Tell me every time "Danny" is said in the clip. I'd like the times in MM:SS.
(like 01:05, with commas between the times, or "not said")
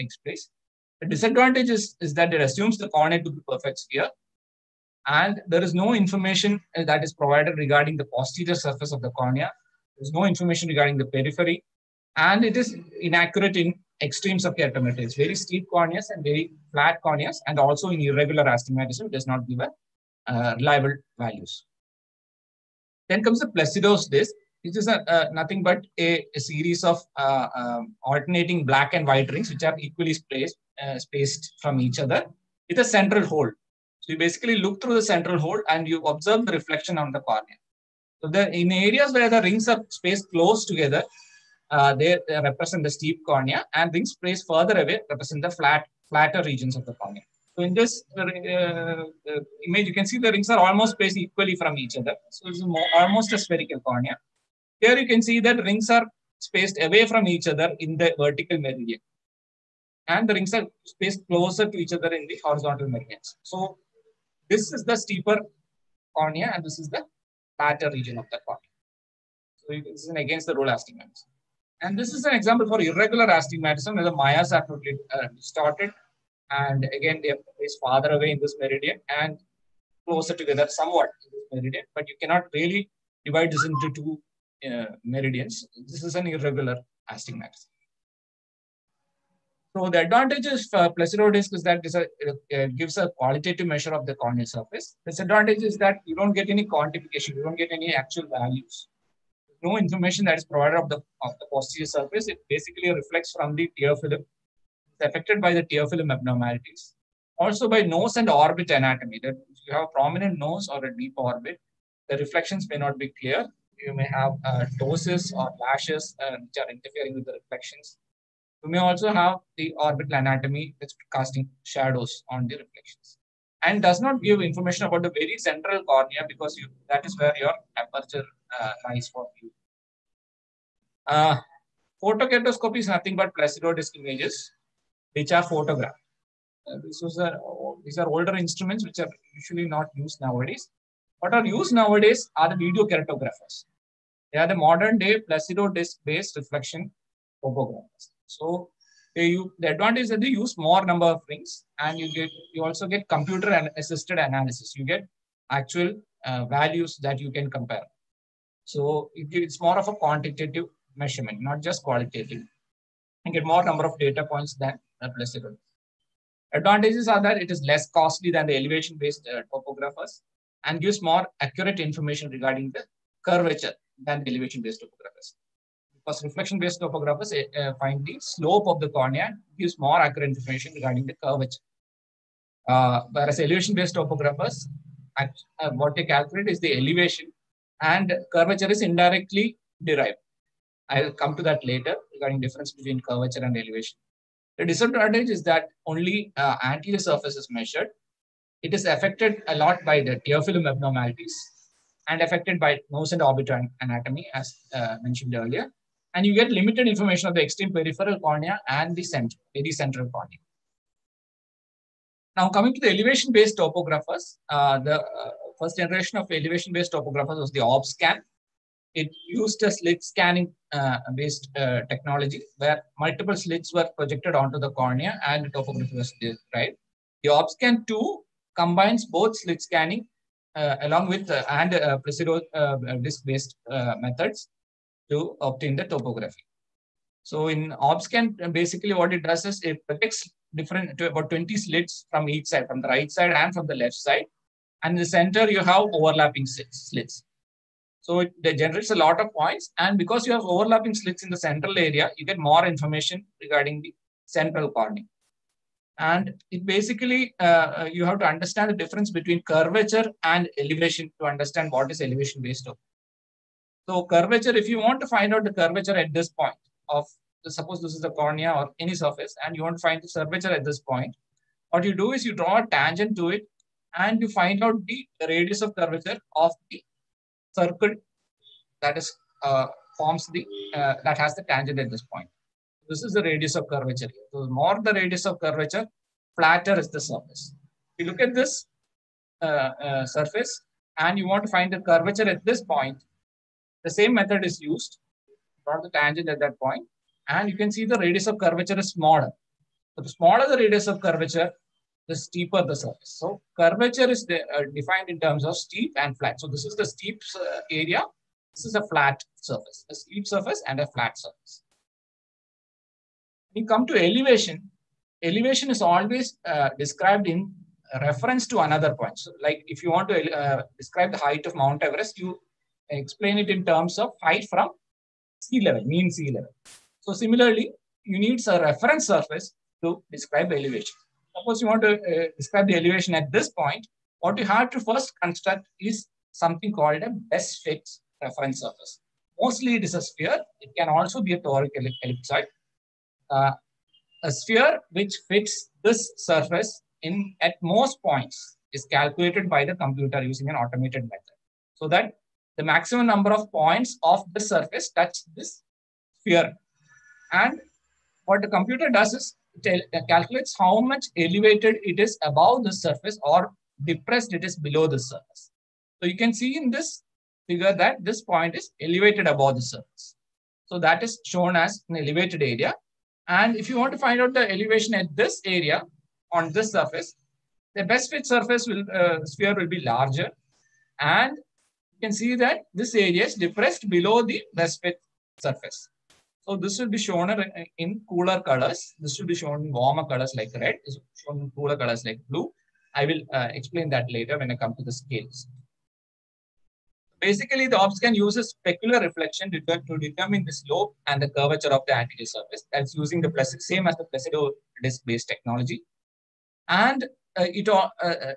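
not said.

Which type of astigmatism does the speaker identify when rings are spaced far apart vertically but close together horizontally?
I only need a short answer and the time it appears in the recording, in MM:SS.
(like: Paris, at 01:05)
against the rule astigmatism, at 01:10.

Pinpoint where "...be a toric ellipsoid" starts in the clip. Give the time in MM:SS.
05:41.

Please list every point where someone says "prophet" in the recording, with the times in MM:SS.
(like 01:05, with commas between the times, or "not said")
not said.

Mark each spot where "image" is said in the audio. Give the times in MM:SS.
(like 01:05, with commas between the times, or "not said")
00:49, 02:13.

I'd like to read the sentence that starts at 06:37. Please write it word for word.
Basically, the OrbScan uses specular reflection to determine the slope and the curvature of the anterior surface.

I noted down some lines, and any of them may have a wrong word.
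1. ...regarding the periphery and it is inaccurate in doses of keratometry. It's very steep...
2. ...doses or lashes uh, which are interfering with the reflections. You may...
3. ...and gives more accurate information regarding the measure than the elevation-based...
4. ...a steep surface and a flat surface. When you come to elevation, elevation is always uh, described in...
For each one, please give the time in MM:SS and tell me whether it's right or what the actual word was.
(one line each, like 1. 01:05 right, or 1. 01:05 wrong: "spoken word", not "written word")
1. 00:10 wrong: "extremes", not "doses"
2. 01:54 right
3. 02:50 wrong: "curvature", not "measure"
4. 05:09 right.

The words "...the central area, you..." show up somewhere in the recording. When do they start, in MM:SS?
04:11.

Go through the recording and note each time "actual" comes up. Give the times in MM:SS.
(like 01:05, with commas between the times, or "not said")
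01:37, 02:35.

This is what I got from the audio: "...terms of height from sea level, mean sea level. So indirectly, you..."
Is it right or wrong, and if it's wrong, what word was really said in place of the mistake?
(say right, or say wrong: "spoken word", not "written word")
wrong: "similarly", not "indirectly".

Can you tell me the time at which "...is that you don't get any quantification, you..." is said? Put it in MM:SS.
01:35.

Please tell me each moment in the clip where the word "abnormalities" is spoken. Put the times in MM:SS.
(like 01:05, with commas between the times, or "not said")
01:46, 03:20.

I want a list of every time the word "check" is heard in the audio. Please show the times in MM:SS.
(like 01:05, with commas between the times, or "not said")
not said.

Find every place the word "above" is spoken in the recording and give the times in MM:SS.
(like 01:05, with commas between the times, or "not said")
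06:02, 06:09.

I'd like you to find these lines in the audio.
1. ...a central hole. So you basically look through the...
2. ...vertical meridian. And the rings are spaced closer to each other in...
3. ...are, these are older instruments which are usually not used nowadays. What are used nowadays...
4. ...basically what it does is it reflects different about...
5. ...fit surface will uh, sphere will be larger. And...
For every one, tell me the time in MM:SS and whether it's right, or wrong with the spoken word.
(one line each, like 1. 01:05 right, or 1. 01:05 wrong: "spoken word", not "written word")
1. 00:32 right
2. 00:58 right
3. 02:17 right
4. 03:58 wrong: "projects", not "reflects"
5. 06:18 right.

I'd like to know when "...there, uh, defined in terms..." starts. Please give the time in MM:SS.
05:04.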